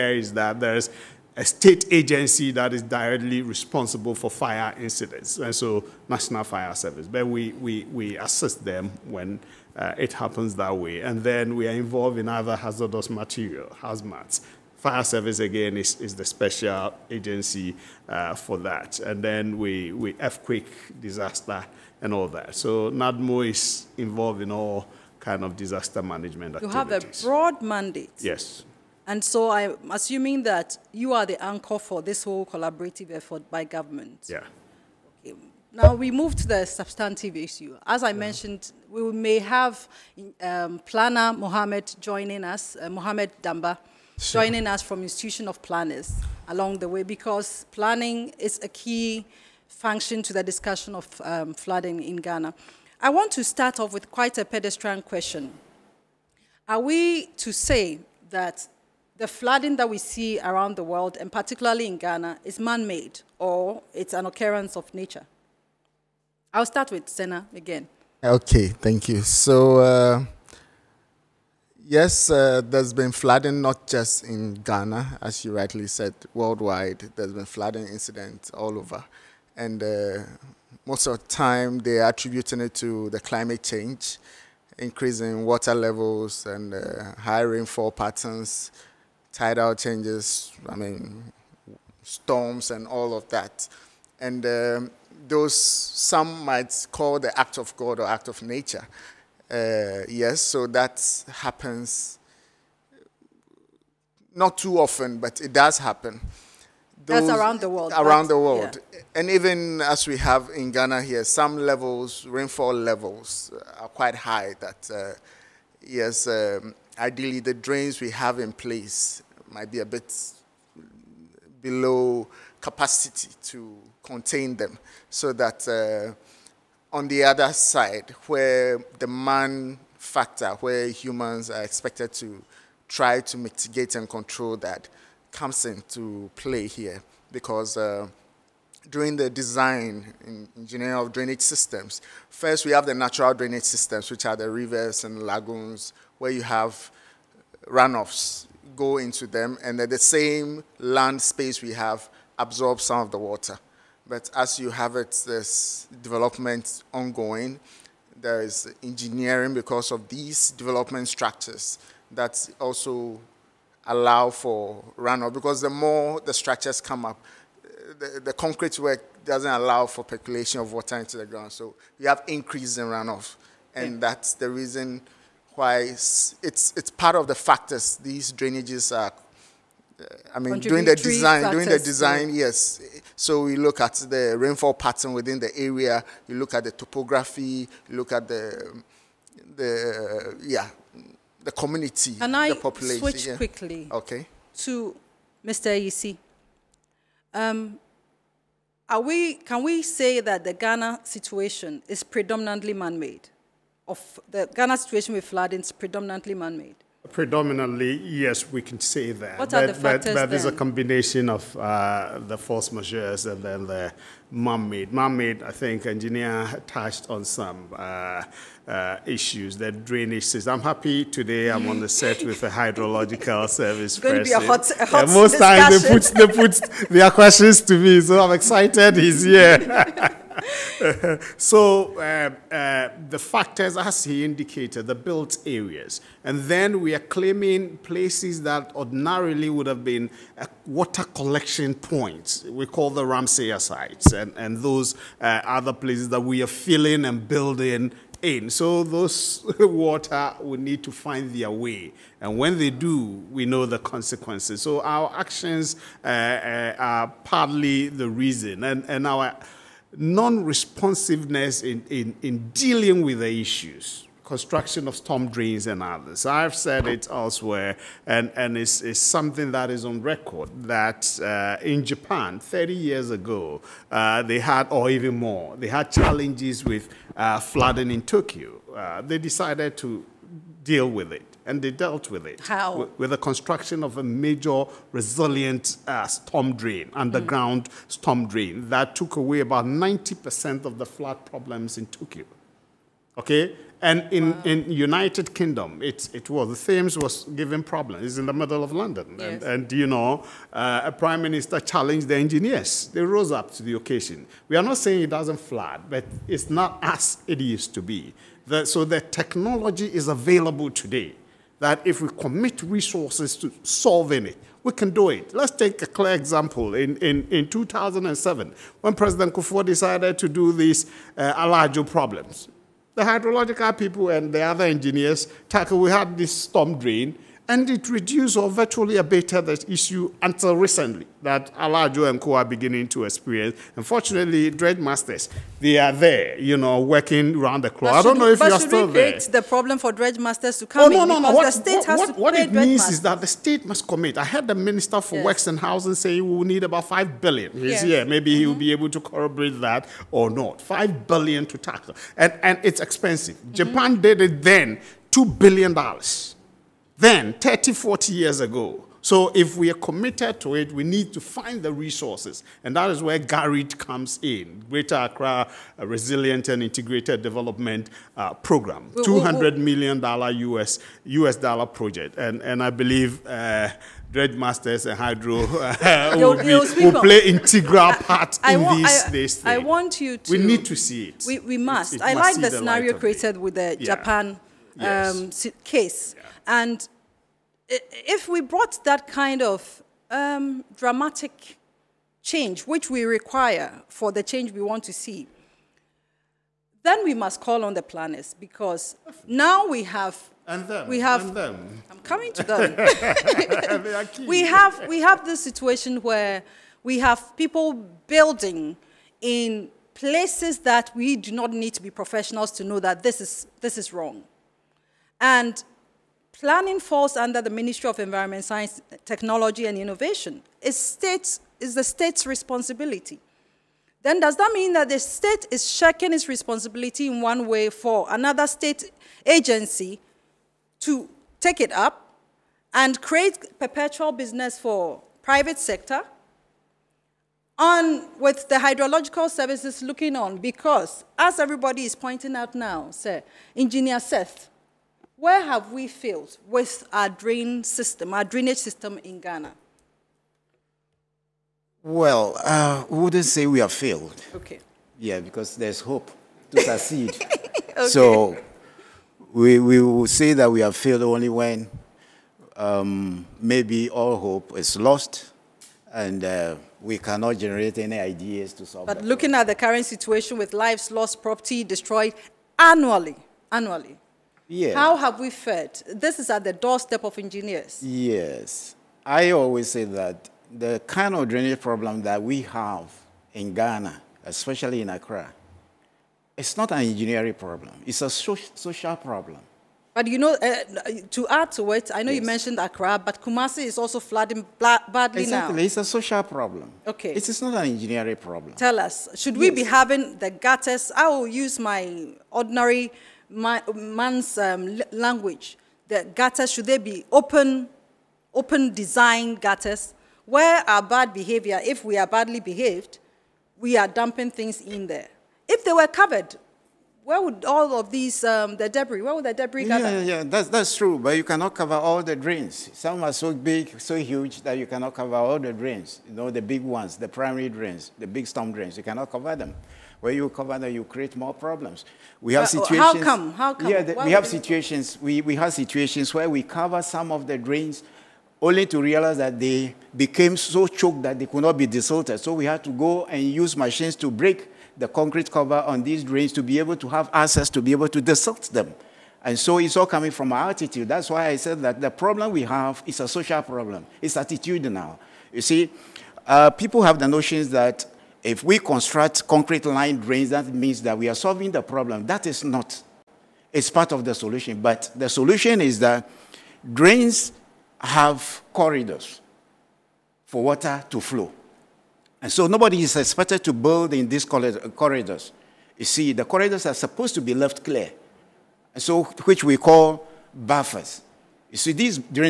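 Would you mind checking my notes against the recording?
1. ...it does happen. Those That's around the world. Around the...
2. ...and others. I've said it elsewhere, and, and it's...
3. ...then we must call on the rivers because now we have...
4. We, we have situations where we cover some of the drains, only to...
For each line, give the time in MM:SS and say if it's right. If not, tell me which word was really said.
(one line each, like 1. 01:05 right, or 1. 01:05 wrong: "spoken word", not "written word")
1. 01:45 right
2. 04:25 right
3. 06:36 wrong: "planners", not "rivers"
4. 08:55 right.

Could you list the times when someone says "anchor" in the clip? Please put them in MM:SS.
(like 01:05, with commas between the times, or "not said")
00:31.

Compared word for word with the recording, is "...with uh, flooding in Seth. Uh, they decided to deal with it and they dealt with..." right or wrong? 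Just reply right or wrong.
wrong.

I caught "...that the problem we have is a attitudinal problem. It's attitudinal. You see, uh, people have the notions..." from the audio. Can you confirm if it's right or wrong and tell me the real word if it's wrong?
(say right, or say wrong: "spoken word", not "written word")
wrong: "social", not "attitudinal".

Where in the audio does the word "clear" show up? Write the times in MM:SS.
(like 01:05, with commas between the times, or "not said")
05:15, 09:37.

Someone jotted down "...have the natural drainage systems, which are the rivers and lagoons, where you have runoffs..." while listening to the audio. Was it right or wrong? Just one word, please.
right.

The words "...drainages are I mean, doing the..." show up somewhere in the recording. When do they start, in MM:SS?
02:58.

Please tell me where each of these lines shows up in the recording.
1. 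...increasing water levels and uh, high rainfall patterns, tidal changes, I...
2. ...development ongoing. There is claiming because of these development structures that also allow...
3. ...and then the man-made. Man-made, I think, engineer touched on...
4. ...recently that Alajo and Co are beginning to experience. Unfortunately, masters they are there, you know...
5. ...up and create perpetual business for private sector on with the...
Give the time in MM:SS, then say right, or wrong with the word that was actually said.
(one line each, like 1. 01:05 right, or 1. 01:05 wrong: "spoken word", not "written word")
1. 01:24 right
2. 02:36 wrong: "engineering", not "claiming"
3. 03:33 right
4. 05:30 right
5. 07:11 right.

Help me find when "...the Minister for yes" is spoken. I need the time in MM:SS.
05:44.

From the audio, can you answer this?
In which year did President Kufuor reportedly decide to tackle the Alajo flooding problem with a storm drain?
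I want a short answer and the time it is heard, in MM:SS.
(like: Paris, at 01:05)
2007, at 05:17.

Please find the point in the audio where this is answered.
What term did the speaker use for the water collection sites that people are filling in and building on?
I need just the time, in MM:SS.
04:03.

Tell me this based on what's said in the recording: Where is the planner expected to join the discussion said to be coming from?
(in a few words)
Institution of planners.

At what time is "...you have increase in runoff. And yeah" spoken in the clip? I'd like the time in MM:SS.
02:51.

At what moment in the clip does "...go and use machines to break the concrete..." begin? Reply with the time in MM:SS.
09:02.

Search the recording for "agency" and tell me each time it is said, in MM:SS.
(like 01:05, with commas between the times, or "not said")
00:01, 00:17, 07:09.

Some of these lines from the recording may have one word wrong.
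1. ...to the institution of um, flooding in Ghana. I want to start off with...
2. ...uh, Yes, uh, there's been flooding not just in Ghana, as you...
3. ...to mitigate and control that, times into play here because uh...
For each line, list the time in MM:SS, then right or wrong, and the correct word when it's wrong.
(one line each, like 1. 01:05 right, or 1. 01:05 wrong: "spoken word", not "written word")
1. 00:50 wrong: "discussion", not "institution"
2. 01:09 right
3. 02:13 wrong: "comes", not "times".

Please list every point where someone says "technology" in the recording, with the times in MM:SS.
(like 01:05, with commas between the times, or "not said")
05:09, 06:59.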